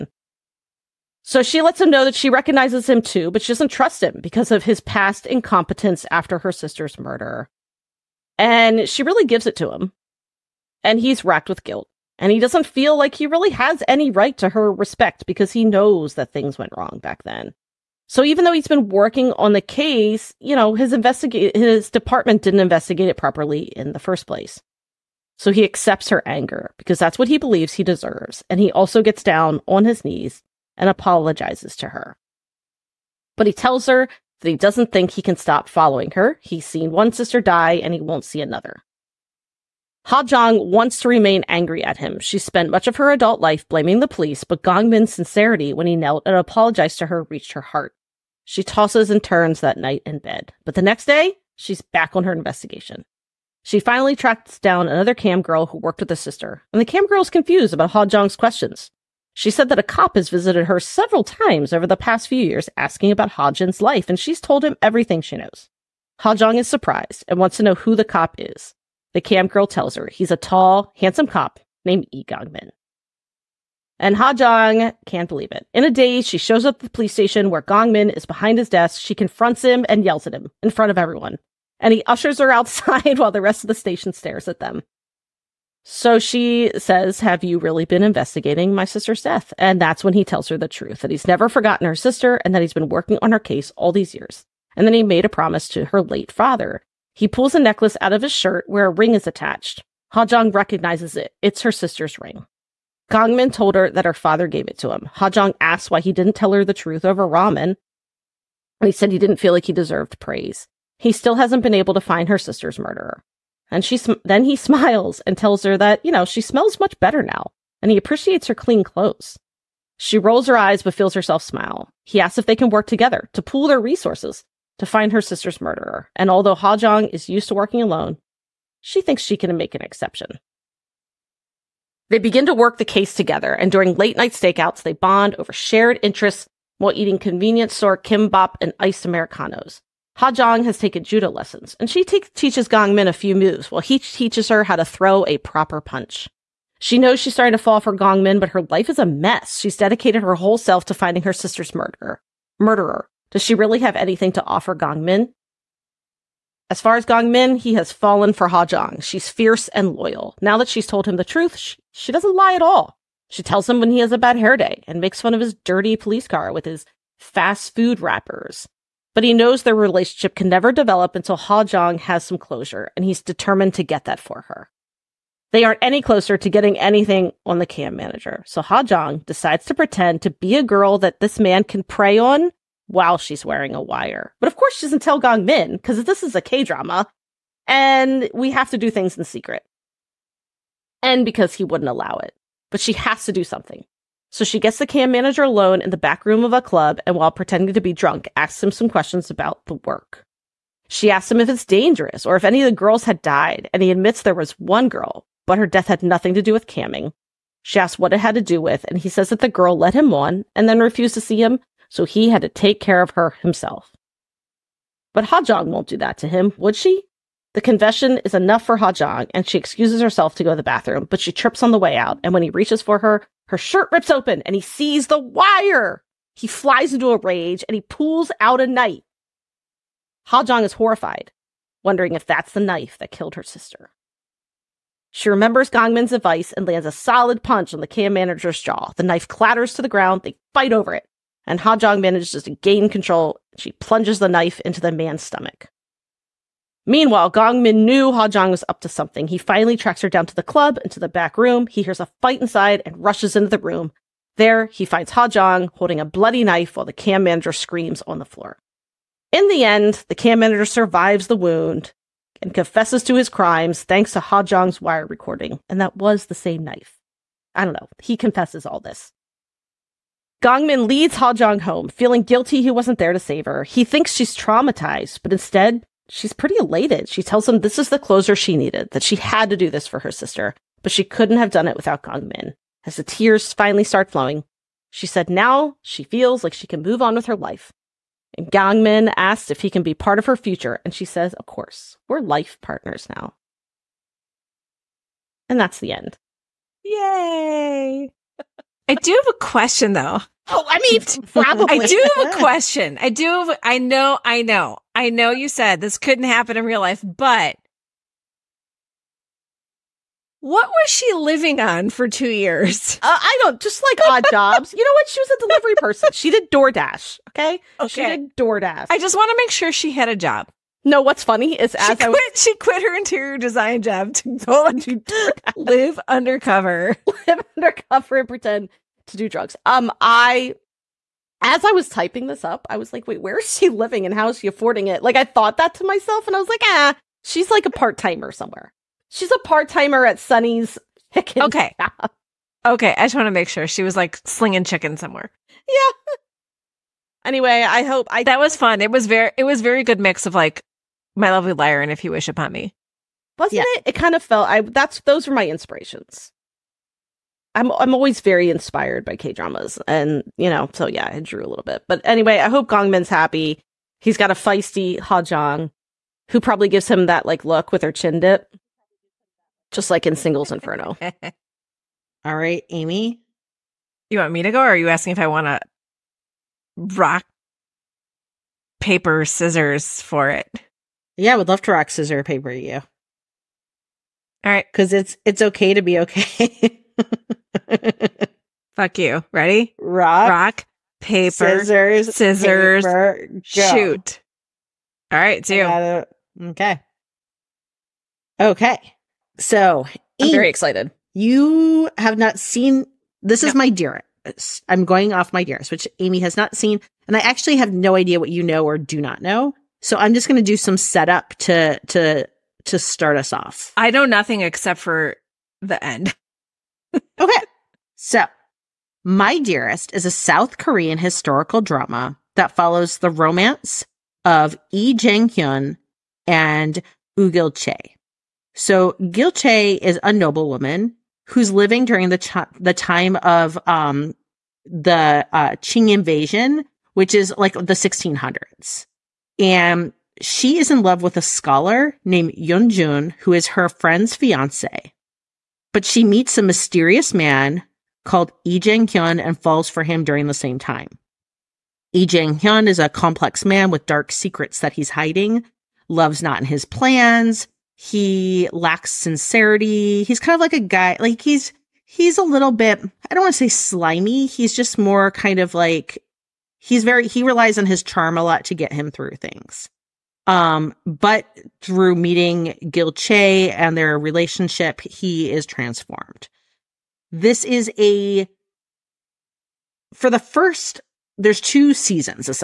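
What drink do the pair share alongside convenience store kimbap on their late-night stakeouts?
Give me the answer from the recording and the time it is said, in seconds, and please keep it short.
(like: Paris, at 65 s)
Iced Americanos, at 138 s.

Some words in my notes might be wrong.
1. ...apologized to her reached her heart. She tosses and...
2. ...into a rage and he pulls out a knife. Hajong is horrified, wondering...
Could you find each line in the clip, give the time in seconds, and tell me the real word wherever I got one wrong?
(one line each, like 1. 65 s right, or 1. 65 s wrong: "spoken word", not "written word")
1. 46 s right
2. 226 s right.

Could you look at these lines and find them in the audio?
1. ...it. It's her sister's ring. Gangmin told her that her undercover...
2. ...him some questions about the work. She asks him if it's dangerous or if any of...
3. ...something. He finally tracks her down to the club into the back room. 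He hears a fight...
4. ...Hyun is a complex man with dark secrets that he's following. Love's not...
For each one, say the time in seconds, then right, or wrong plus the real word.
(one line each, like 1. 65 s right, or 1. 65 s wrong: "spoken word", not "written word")
1. 101 s wrong: "father", not "undercover"
2. 198 s right
3. 248 s right
4. 452 s wrong: "hiding", not "following".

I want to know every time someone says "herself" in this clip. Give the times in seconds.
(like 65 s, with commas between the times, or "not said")
121 s, 220 s.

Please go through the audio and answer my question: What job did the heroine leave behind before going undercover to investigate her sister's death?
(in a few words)
Interior design.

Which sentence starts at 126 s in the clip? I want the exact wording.
And although Ha Hajong is used to working alone, she thinks she can make an exception.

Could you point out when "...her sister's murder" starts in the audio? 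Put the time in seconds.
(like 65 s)
6 s.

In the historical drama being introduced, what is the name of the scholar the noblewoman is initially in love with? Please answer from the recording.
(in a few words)
Yunjun.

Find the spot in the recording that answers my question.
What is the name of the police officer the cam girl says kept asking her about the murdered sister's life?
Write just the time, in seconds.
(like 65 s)
72 s.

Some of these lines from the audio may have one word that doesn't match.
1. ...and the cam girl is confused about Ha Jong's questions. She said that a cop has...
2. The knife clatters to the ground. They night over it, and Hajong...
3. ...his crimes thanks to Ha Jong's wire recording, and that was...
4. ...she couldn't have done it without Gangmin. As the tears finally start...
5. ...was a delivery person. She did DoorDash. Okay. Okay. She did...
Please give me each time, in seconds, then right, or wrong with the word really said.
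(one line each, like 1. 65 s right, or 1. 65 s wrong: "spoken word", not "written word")
1. 56 s right
2. 238 s wrong: "fight", not "night"
3. 263 s right
4. 280 s right
5. 315 s right.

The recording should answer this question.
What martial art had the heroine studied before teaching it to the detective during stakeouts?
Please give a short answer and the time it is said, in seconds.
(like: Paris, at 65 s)
Judo, at 141 s.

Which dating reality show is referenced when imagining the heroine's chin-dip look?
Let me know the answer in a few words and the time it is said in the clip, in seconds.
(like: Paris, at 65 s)
Singles Inferno, at 370 s.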